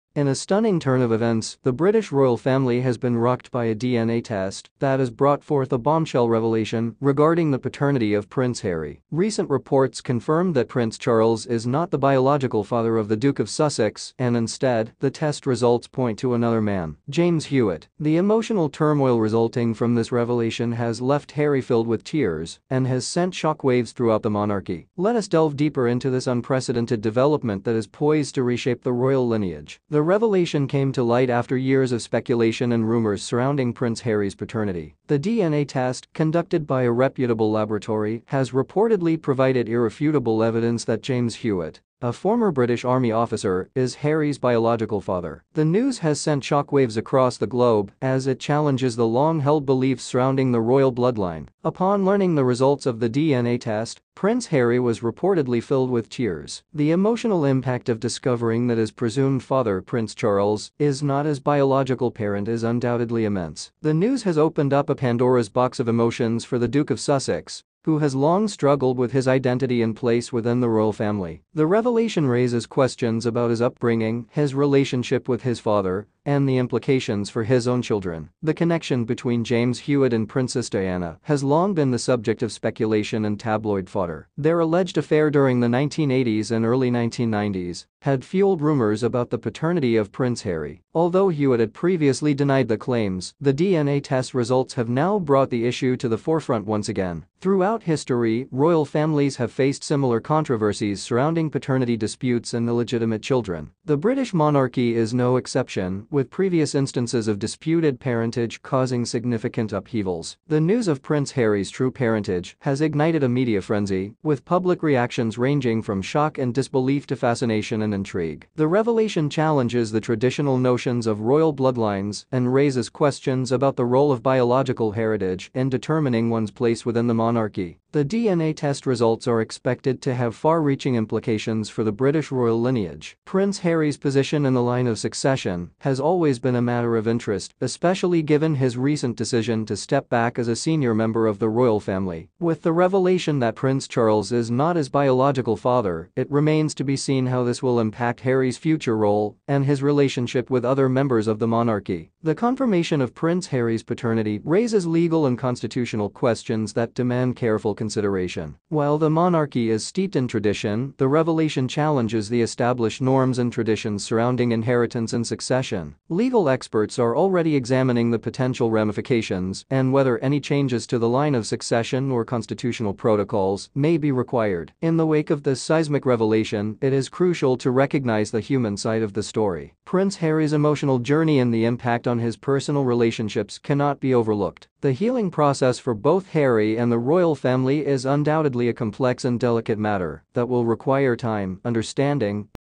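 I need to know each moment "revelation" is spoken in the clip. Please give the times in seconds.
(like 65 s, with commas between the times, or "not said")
6 s, 20 s, 30 s, 71 s, 118 s, 142 s, 161 s, 176 s.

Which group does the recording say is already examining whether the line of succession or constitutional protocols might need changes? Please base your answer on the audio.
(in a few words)
Legal experts.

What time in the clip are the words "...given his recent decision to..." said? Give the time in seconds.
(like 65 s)
138 s.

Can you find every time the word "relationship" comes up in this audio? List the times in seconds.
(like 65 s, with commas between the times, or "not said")
74 s, 149 s, 182 s.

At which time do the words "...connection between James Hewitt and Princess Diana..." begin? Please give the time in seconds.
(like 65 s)
78 s.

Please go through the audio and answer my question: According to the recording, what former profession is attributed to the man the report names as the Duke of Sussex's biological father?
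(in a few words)
Former British Army officer.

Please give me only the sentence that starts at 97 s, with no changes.
Throughout history, royal families have faced similar controversies surrounding paternity disputes and illegitimate children.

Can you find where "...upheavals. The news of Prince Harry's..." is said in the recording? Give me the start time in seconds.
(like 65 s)
109 s.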